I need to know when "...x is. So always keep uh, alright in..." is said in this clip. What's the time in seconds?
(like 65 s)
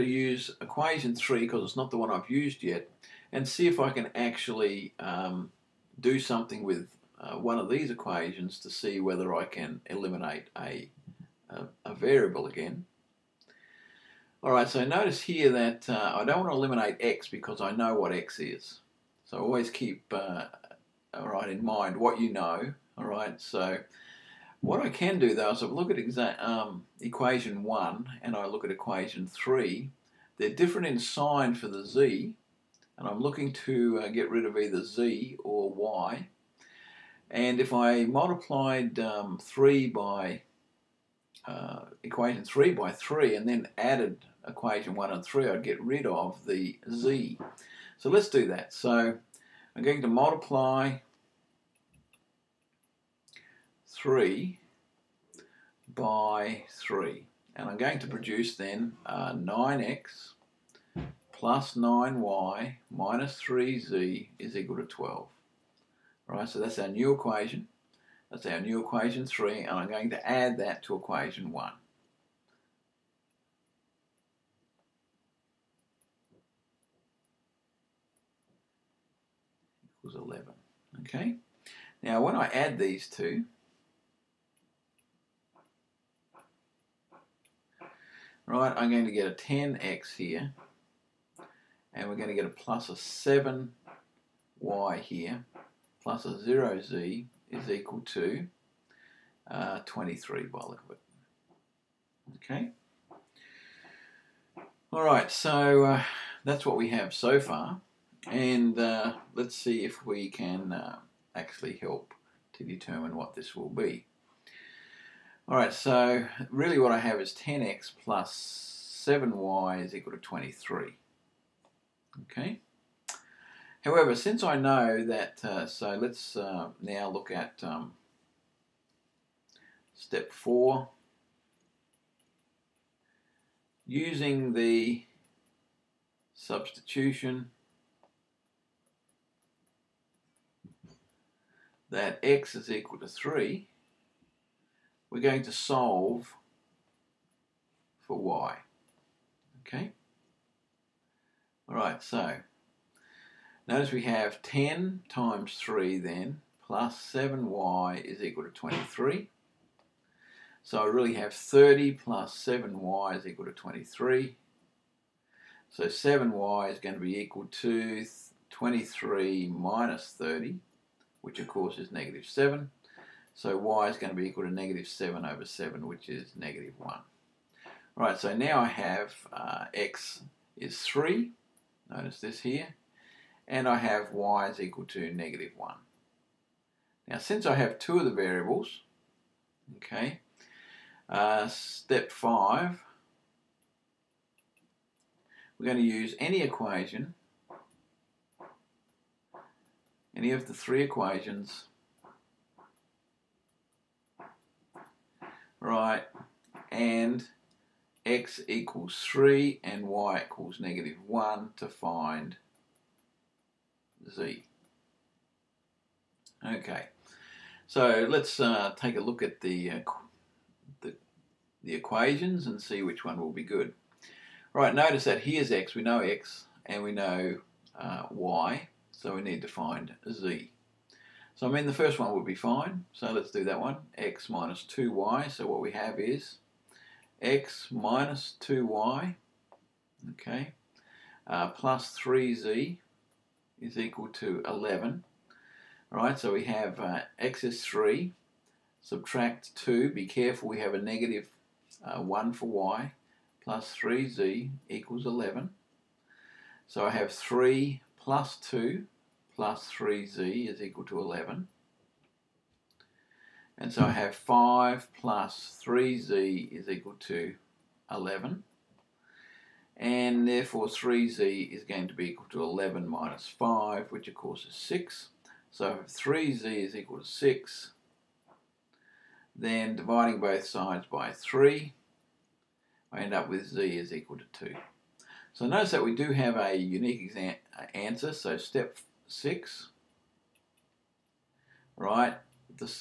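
18 s.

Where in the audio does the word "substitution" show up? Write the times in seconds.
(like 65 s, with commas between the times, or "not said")
136 s.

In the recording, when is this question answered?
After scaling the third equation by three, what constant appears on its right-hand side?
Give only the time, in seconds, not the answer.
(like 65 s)
64 s.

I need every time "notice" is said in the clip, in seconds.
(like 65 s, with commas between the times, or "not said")
14 s, 153 s, 181 s, 224 s, 285 s.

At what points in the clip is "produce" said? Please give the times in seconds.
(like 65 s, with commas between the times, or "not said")
58 s.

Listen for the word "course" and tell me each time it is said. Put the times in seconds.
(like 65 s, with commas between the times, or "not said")
171 s, 274 s.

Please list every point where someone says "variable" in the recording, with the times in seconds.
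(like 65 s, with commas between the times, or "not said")
11 s, 188 s.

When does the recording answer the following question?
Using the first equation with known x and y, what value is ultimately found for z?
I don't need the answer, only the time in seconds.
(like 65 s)
283 s.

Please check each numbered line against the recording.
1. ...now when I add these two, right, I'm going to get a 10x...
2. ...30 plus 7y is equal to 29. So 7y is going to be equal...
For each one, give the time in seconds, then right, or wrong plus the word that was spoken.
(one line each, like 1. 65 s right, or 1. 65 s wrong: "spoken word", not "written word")
1. 82 s right
2. 161 s wrong: "23", not "29".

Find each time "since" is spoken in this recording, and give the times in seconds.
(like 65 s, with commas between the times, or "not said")
124 s, 187 s.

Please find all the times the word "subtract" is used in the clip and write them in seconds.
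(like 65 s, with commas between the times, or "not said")
248 s.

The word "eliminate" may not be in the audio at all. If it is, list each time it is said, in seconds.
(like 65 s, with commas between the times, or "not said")
9 s, 16 s.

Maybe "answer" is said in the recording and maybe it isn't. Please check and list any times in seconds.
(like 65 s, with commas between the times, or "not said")
287 s.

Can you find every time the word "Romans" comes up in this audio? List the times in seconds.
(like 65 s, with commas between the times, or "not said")
not said.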